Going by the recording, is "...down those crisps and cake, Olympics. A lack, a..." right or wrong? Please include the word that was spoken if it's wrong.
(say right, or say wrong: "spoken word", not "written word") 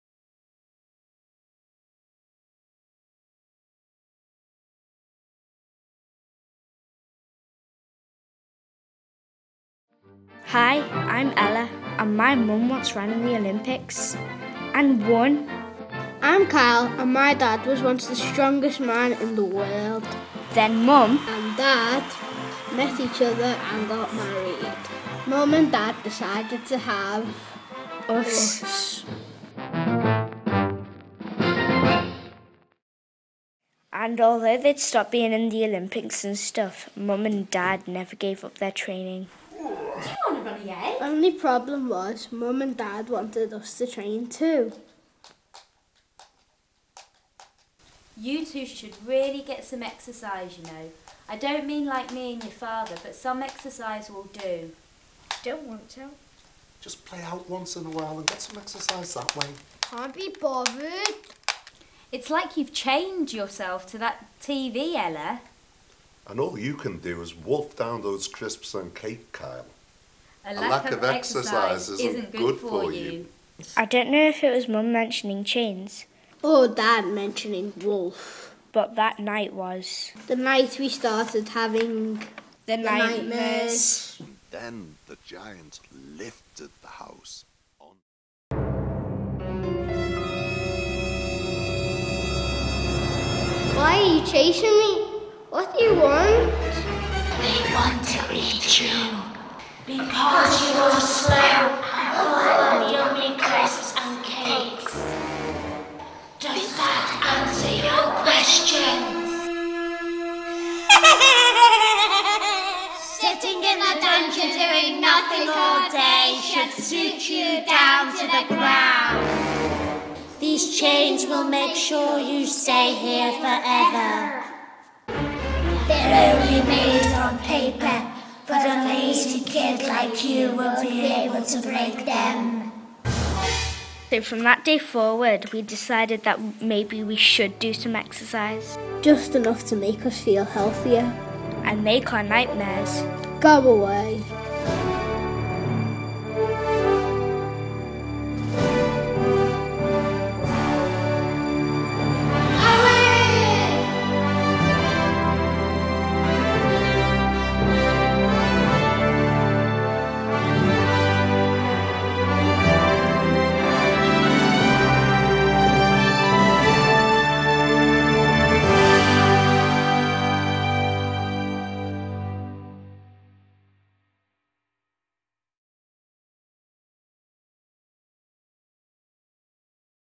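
wrong: "Kyle", not "Olympics".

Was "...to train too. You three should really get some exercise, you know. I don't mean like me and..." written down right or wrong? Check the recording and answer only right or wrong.
wrong.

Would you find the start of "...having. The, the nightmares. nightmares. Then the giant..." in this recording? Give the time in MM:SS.
01:21.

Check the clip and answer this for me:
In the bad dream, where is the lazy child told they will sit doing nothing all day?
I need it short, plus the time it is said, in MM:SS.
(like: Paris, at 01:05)
The dungeon, at 01:54.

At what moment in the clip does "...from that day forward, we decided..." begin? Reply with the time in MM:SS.
02:14.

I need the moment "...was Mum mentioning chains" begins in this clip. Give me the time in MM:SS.
01:14.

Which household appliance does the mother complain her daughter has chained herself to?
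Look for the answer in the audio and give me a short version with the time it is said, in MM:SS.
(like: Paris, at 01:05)
TV, at 01:04.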